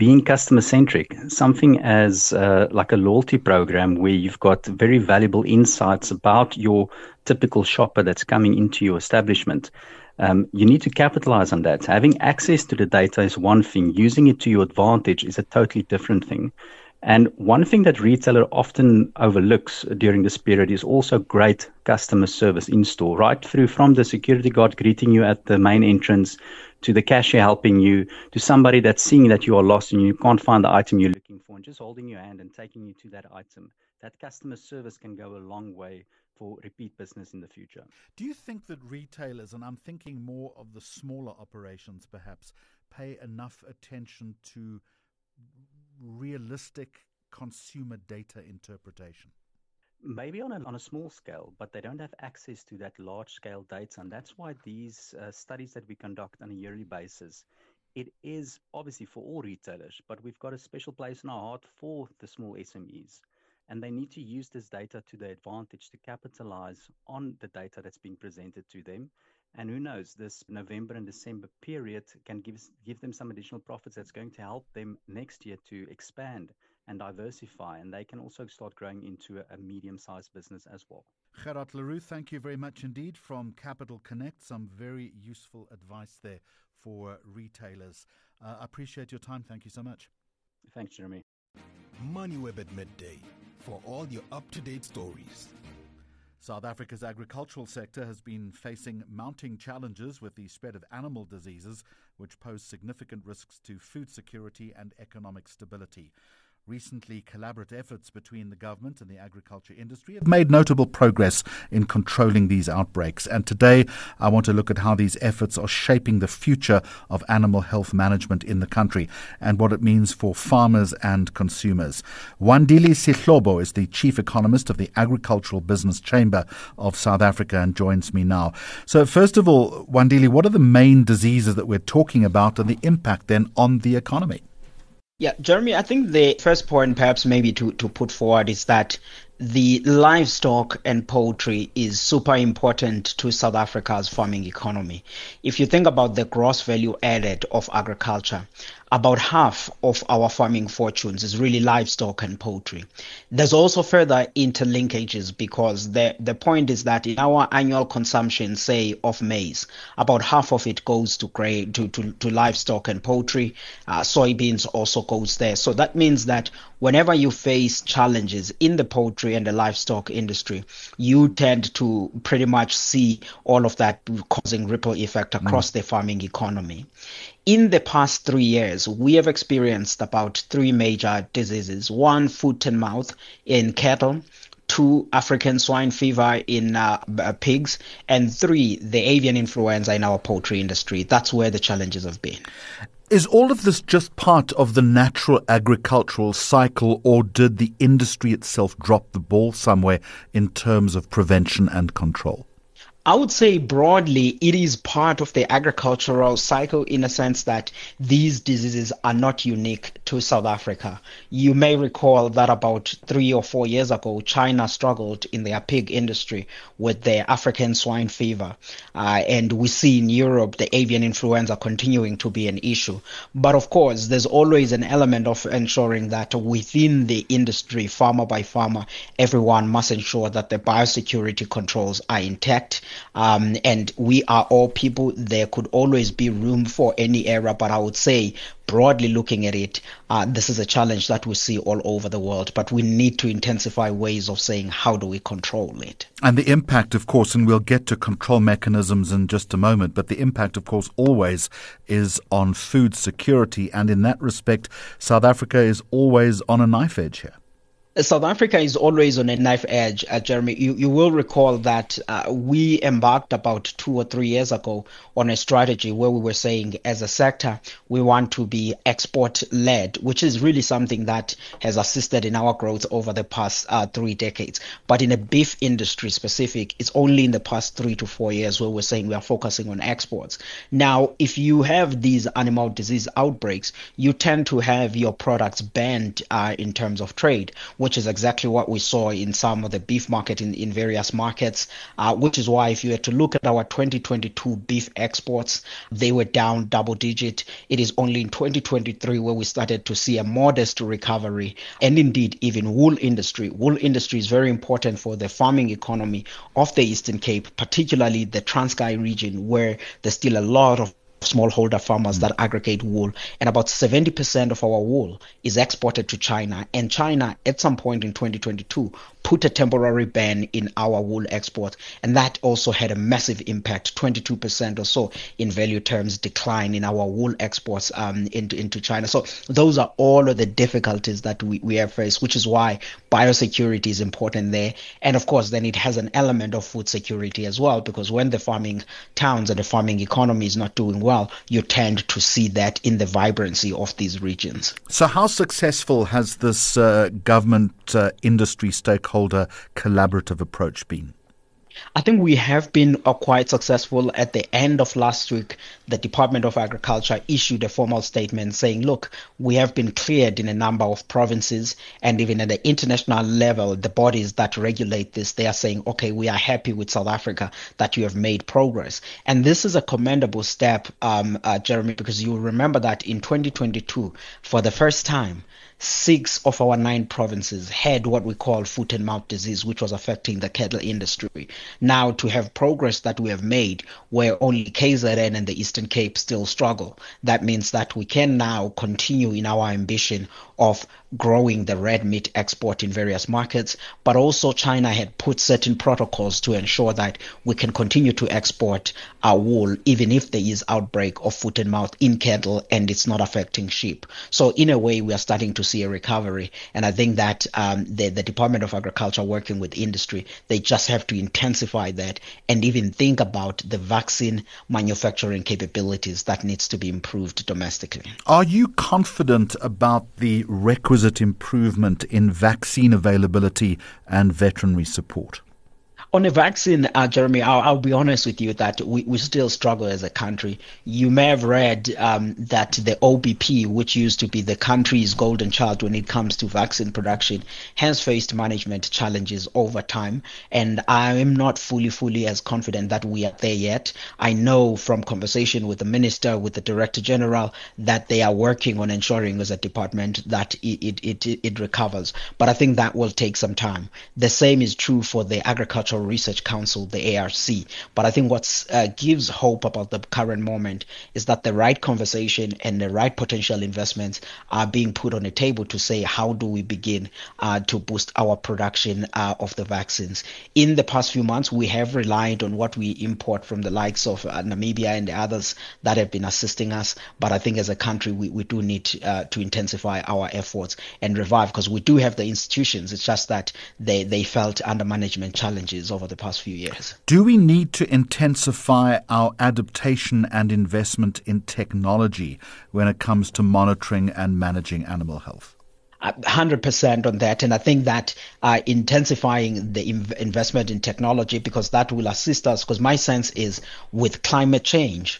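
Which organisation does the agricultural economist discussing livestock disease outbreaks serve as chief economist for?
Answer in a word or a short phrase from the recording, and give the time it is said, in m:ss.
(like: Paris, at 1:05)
Agricultural Business Chamber of South Africa, at 2:04.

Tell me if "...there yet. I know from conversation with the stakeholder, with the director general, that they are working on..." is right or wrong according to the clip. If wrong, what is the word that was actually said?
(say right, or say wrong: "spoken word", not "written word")
wrong: "minister", not "stakeholder".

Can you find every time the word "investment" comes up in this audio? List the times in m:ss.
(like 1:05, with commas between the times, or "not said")
7:43, 8:10, 8:20.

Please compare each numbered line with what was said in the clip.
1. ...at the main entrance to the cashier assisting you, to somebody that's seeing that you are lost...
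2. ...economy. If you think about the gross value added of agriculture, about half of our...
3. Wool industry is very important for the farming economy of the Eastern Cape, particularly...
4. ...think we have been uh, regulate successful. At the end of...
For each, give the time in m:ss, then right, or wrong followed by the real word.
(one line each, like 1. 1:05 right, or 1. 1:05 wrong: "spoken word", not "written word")
1. 0:25 wrong: "helping", not "assisting"
2. 2:24 right
3. 5:03 right
4. 5:52 wrong: "quite", not "regulate".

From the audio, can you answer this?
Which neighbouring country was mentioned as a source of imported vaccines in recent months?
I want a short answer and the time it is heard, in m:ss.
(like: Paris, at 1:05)
Namibia, at 7:54.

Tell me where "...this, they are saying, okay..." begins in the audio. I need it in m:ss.
6:05.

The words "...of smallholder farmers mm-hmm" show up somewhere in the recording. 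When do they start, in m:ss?
5:10.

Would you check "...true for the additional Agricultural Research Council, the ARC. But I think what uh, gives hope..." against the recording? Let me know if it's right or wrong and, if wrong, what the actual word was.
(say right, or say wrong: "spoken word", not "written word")
wrong: "agricultural", not "additional".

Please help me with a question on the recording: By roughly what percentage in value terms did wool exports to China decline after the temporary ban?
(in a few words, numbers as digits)
22%.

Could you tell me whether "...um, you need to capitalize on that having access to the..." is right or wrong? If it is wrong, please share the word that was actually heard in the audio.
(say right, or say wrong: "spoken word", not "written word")
right.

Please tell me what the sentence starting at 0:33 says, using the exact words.
That customer service can go a long way for repeat business in the future.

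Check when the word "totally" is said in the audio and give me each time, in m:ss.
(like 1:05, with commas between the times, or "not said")
0:15.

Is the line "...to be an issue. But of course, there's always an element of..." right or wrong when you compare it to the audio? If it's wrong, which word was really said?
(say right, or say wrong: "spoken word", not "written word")
right.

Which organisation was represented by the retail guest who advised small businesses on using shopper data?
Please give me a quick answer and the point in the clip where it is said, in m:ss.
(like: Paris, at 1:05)
Capital Connect, at 1:23.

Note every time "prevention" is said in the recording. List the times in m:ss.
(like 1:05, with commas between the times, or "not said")
3:21.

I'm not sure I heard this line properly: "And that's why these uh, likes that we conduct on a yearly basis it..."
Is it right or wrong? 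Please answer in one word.
wrong.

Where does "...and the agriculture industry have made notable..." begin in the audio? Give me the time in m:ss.
1:49.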